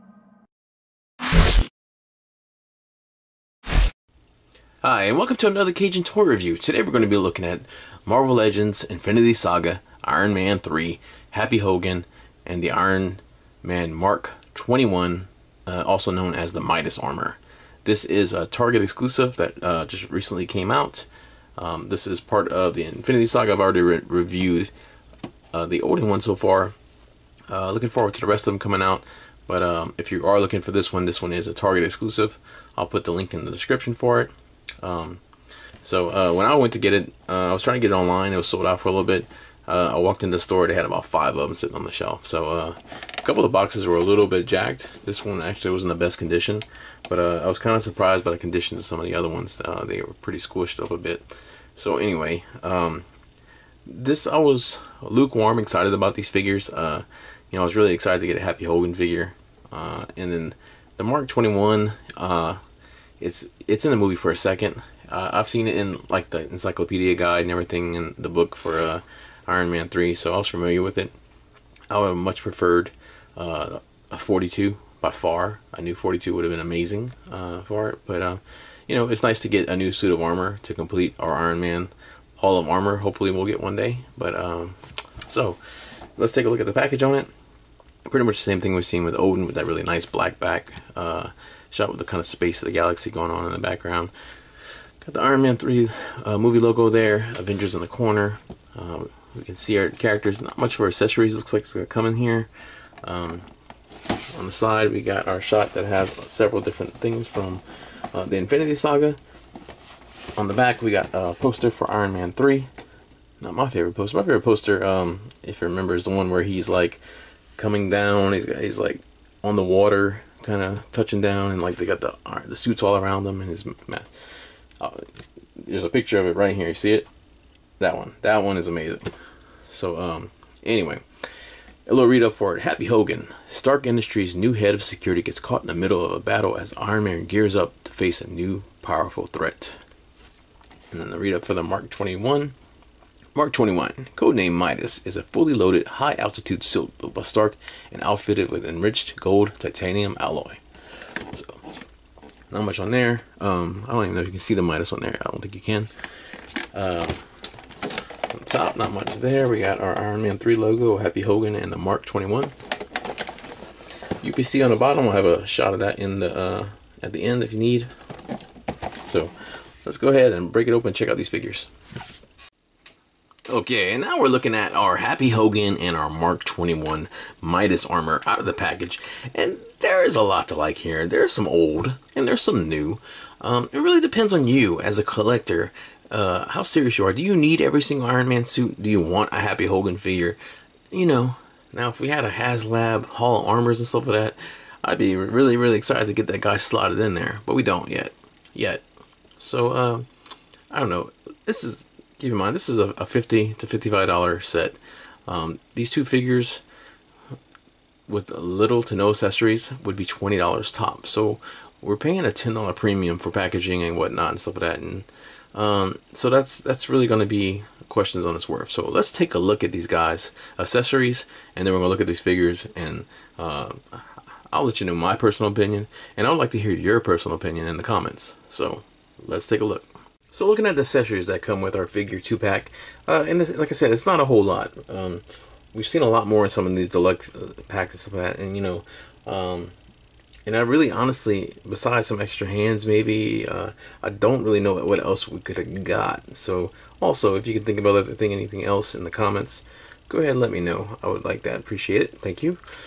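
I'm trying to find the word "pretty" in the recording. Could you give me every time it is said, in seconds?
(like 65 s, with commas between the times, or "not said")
50 s, 88 s.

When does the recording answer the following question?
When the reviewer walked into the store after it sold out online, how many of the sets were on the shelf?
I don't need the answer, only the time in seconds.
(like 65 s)
41 s.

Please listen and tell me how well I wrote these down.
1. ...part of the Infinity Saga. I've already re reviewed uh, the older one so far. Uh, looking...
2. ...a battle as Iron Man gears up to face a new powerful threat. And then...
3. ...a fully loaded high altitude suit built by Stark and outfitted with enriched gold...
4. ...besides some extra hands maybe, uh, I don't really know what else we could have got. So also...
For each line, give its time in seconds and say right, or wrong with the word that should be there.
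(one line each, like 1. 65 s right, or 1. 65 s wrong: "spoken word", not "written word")
1. 22 s right
2. 136 s right
3. 145 s right
4. 241 s right.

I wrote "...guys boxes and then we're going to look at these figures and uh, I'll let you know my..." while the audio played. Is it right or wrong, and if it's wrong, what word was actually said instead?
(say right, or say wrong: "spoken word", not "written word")
wrong: "accessories", not "boxes".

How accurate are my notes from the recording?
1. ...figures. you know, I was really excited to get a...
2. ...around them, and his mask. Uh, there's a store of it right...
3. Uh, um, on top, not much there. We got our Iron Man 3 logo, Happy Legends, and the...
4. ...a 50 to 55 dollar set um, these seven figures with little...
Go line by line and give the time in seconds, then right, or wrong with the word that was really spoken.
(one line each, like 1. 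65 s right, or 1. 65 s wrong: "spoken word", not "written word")
1. 56 s right
2. 122 s wrong: "picture", not "store"
3. 156 s wrong: "Hogan", not "Legends"
4. 202 s wrong: "two", not "seven".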